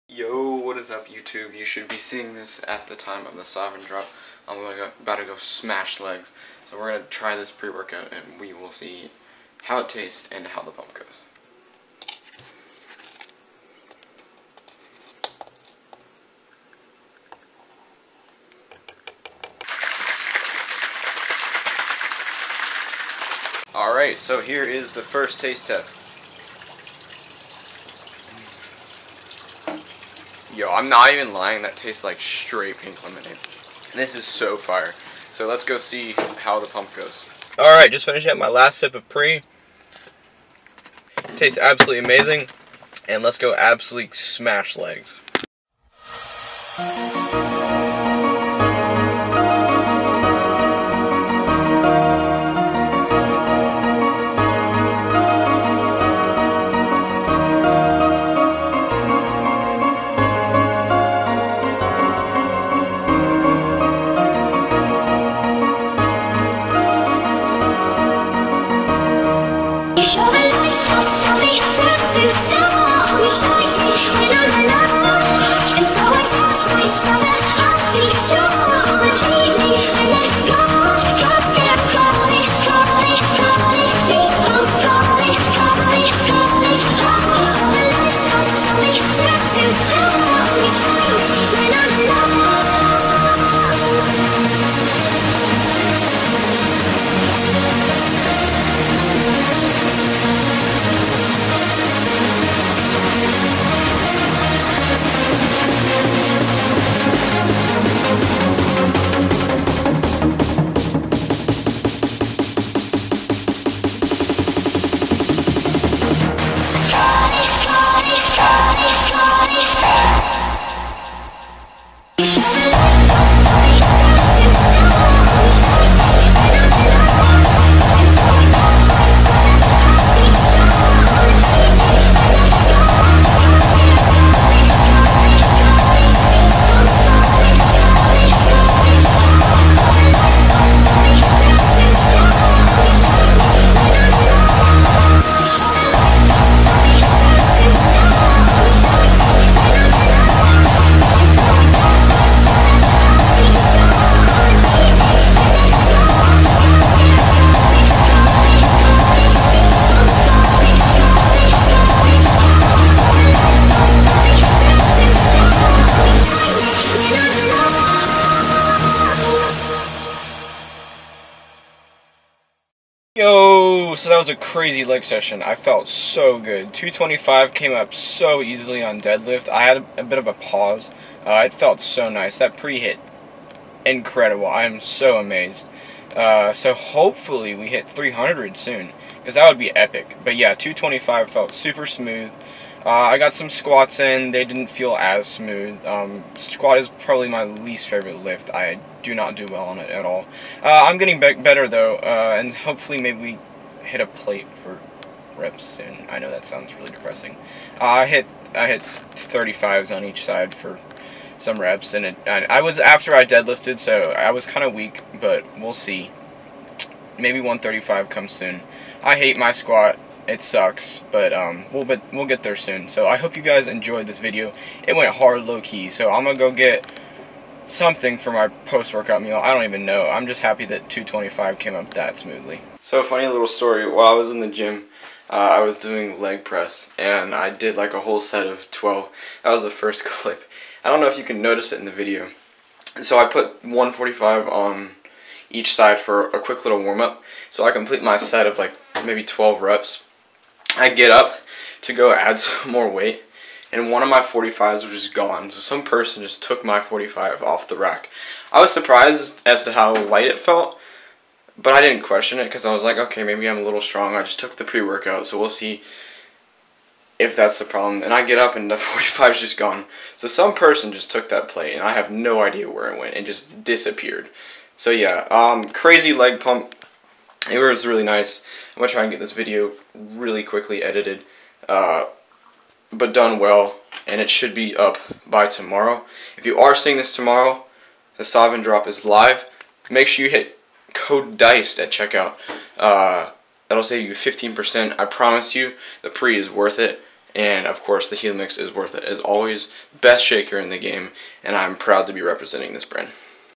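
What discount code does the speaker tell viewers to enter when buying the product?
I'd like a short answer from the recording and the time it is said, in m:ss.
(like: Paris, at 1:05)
DICED, at 4:51.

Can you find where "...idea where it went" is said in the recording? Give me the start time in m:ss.
4:32.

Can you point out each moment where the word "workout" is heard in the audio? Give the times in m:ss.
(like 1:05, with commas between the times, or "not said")
0:07, 3:48, 4:24.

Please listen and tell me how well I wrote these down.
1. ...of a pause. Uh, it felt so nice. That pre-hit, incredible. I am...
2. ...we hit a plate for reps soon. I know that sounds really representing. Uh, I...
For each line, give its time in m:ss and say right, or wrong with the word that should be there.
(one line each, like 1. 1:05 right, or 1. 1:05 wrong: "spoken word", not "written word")
1. 3:00 right
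2. 3:23 wrong: "depressing", not "representing".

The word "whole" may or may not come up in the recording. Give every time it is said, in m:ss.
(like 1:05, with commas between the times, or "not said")
3:57.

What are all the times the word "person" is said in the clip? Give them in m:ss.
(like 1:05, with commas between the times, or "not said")
4:15, 4:30.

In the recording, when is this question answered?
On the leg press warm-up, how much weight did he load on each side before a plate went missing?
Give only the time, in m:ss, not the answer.
4:03.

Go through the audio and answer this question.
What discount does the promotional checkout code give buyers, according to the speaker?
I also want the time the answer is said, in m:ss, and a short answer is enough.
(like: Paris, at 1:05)
15%, at 4:54.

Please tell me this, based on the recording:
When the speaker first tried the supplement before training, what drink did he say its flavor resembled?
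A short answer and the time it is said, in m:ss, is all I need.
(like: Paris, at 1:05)
pink lemonade, at 0:32.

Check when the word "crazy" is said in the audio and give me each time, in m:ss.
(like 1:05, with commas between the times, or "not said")
2:54, 4:35.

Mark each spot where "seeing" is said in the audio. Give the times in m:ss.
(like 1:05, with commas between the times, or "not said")
0:01, 4:46.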